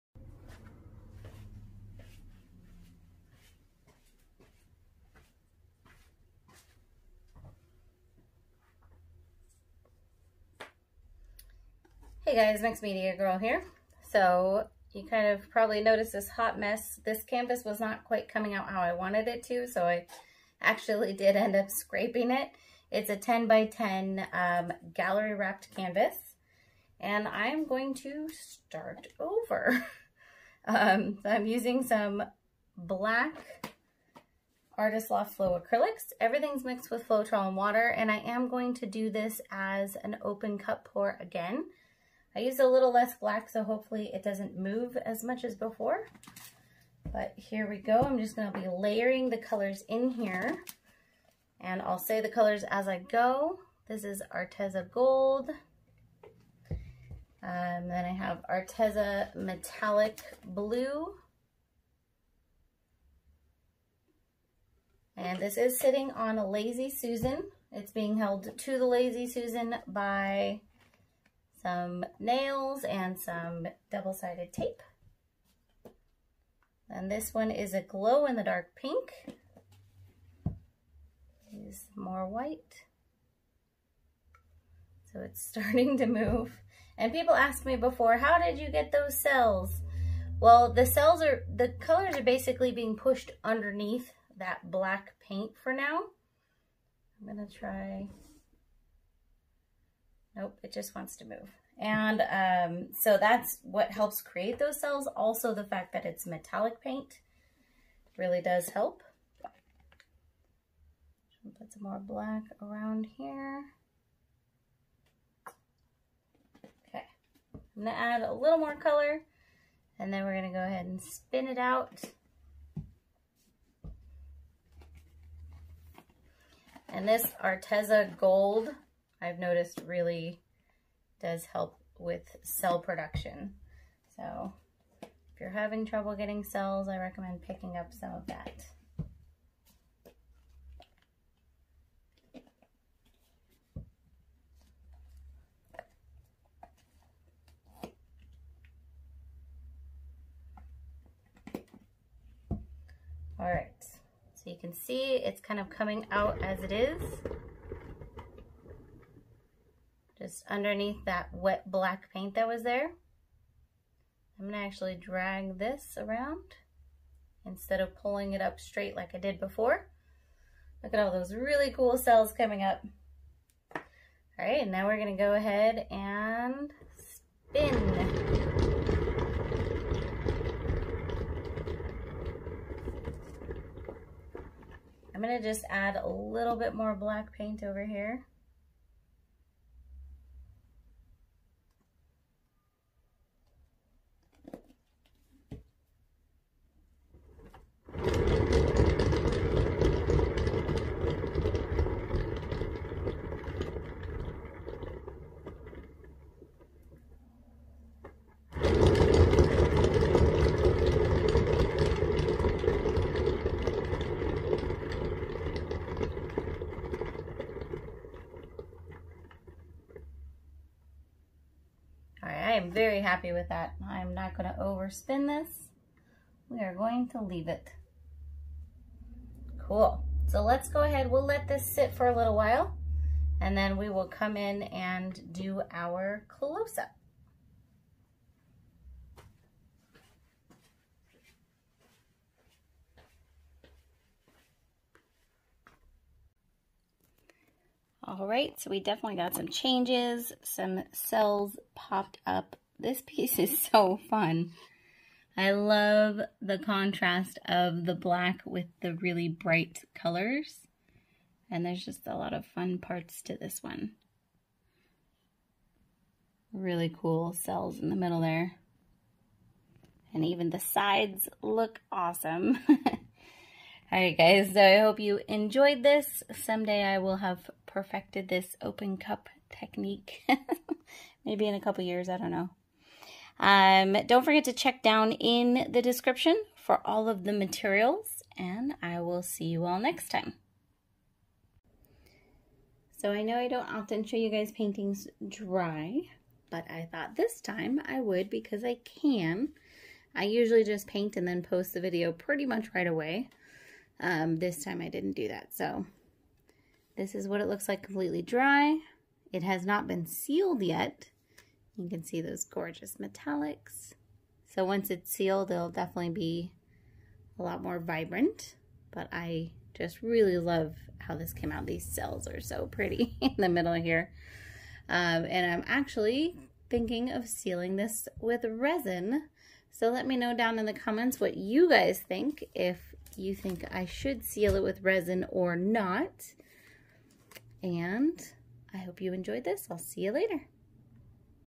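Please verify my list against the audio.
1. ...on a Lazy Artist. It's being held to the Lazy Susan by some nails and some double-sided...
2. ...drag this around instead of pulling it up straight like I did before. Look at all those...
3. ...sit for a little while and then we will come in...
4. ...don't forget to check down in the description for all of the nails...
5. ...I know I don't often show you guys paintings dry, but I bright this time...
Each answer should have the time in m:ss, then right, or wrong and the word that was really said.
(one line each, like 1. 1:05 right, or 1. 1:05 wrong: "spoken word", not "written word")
1. 1:06 wrong: "Susan", not "Artist"
2. 2:44 right
3. 3:51 right
4. 4:44 wrong: "materials", not "nails"
5. 4:53 wrong: "thought", not "bright".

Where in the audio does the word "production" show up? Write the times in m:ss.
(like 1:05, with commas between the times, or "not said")
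2:12.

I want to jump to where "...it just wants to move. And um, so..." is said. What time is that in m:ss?
1:40.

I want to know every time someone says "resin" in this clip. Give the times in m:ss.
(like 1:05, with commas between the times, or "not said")
5:28, 5:34.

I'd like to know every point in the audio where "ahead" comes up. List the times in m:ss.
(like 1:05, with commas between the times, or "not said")
2:00, 2:55, 3:50.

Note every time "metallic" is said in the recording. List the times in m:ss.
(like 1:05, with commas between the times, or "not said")
0:59, 1:46, 5:12.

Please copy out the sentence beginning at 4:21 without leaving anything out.
And there's just a lot of fun parts to this one.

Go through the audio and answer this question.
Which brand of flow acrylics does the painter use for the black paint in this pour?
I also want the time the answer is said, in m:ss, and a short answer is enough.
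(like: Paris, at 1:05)
Artist Loft, at 0:34.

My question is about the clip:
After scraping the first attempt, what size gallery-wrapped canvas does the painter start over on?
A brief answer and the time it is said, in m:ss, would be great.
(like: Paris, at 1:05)
10 by 10, at 0:23.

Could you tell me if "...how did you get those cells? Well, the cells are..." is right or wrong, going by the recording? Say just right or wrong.
right.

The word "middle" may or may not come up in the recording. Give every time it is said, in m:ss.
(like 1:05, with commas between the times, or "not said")
4:27, 5:23.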